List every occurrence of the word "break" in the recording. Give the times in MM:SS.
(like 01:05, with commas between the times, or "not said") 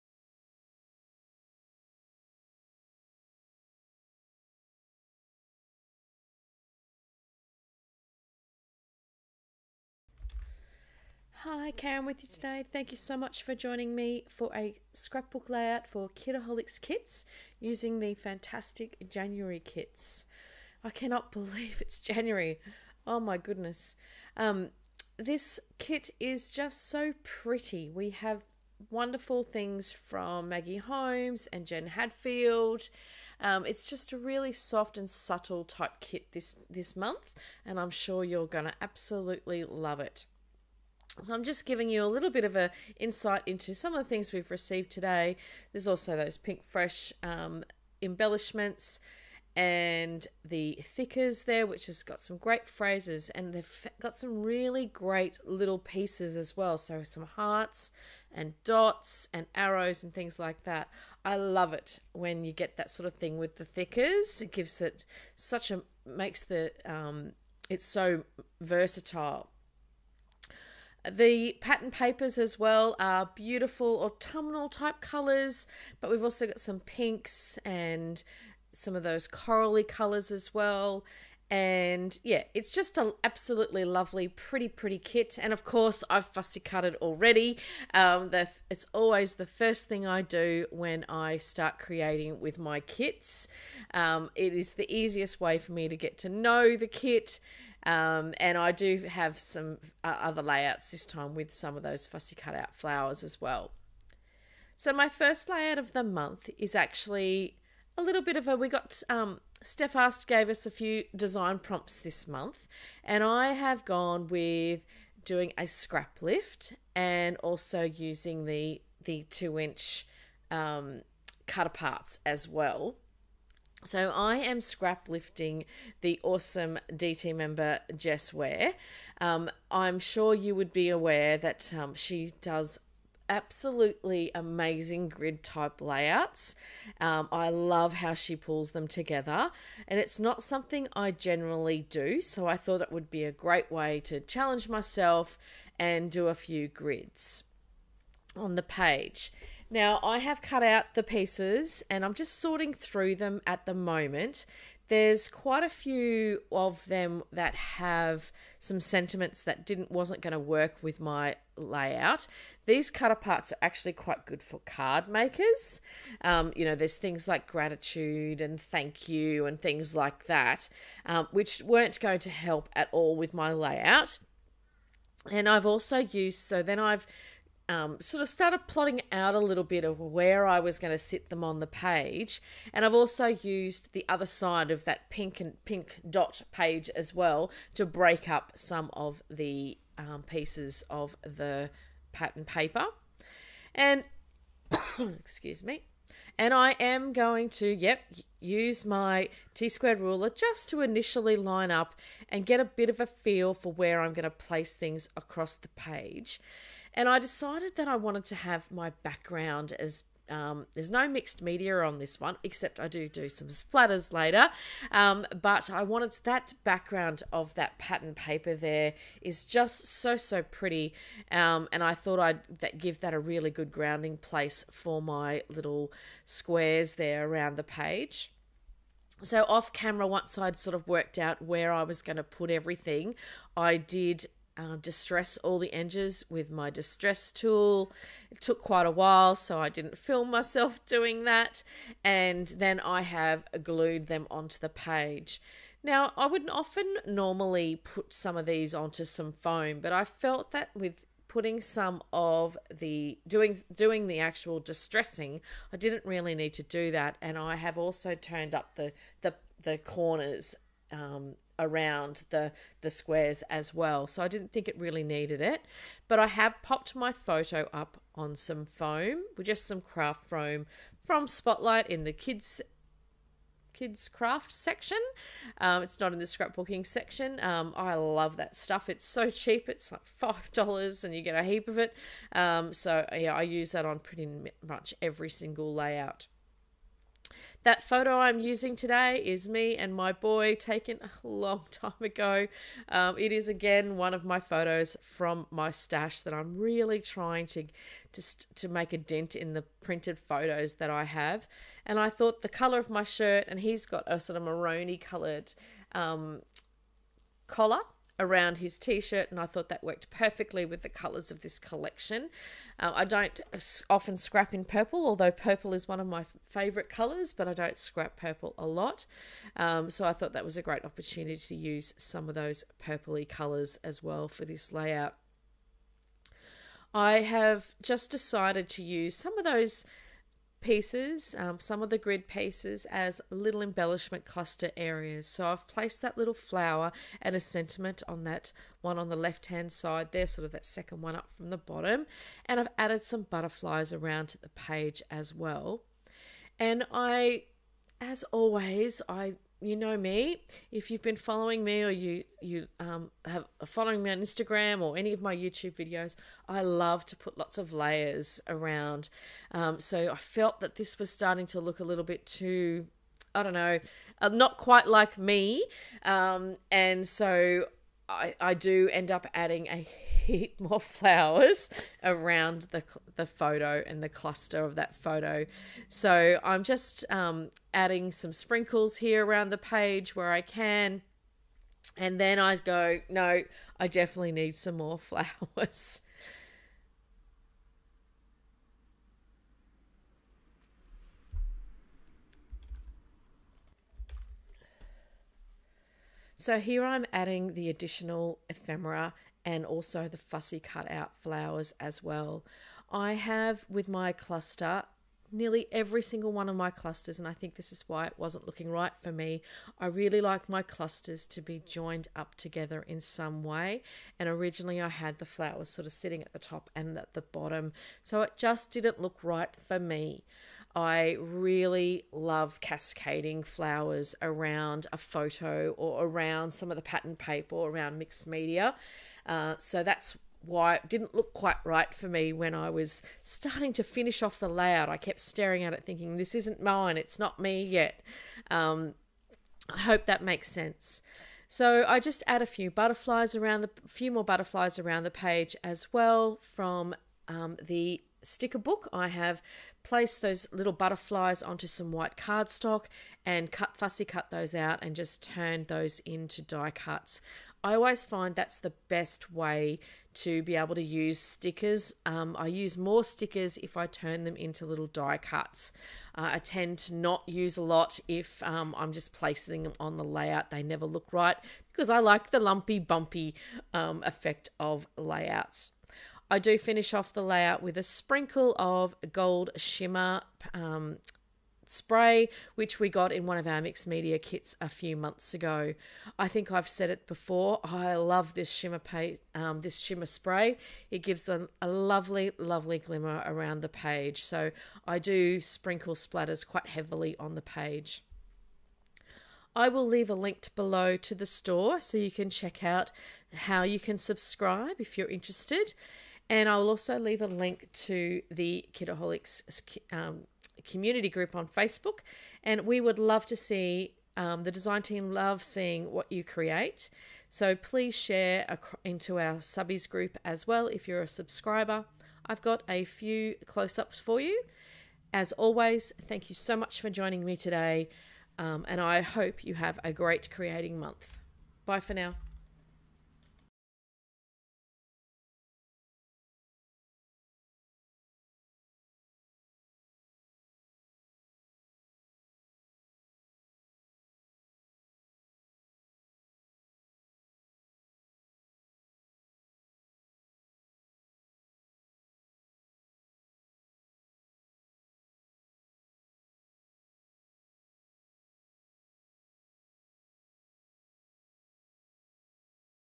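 03:07.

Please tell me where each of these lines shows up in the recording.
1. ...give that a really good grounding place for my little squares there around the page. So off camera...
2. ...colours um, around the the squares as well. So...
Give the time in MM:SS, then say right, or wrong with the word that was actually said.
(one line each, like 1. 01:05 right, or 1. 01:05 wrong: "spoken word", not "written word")
1. 03:42 right
2. 04:19 wrong: "corners", not "colours".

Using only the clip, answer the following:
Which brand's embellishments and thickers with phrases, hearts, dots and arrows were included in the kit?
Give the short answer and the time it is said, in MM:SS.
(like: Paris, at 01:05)
Pinkfresh, at 00:46.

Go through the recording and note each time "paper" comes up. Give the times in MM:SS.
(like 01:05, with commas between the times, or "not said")
01:11, 03:12, 03:38, 07:07.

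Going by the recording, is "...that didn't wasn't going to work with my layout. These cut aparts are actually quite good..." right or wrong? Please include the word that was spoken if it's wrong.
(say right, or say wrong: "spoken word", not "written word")
right.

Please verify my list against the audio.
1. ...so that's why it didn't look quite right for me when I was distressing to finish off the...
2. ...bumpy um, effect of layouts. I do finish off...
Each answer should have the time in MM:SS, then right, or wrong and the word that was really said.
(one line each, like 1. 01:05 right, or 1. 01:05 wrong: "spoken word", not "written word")
1. 07:09 wrong: "starting", not "distressing"
2. 07:52 right.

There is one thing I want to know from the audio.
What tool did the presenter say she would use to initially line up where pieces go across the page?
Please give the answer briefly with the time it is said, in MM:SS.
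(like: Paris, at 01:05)
T squared ruler, at 03:19.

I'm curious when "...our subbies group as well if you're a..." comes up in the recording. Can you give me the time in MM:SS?
08:39.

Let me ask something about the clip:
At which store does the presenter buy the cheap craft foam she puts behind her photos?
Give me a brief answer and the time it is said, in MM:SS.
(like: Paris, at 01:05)
Spotlight, at 04:31.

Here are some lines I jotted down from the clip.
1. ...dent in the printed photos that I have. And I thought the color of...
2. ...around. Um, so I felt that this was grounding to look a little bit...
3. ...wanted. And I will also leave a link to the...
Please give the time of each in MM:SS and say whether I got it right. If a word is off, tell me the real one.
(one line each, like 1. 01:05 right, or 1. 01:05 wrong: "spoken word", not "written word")
1. 04:58 right
2. 05:58 wrong: "starting", not "grounding"
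3. 08:25 wrong: "interested", not "wanted".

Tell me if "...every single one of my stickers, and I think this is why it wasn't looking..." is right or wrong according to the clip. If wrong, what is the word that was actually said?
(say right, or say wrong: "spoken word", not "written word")
wrong: "clusters", not "stickers".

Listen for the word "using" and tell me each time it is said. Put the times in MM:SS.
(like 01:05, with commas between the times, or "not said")
00:17, 01:57, 04:48.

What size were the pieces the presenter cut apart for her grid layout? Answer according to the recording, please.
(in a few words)
2 inch.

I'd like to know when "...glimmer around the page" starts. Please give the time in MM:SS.
08:12.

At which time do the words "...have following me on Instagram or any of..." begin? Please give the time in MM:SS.
05:53.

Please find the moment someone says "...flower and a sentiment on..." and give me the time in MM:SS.
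05:36.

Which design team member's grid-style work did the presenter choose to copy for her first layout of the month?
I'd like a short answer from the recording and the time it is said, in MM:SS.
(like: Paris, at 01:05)
Jess Ware, at 02:07.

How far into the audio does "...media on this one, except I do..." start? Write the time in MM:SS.
03:31.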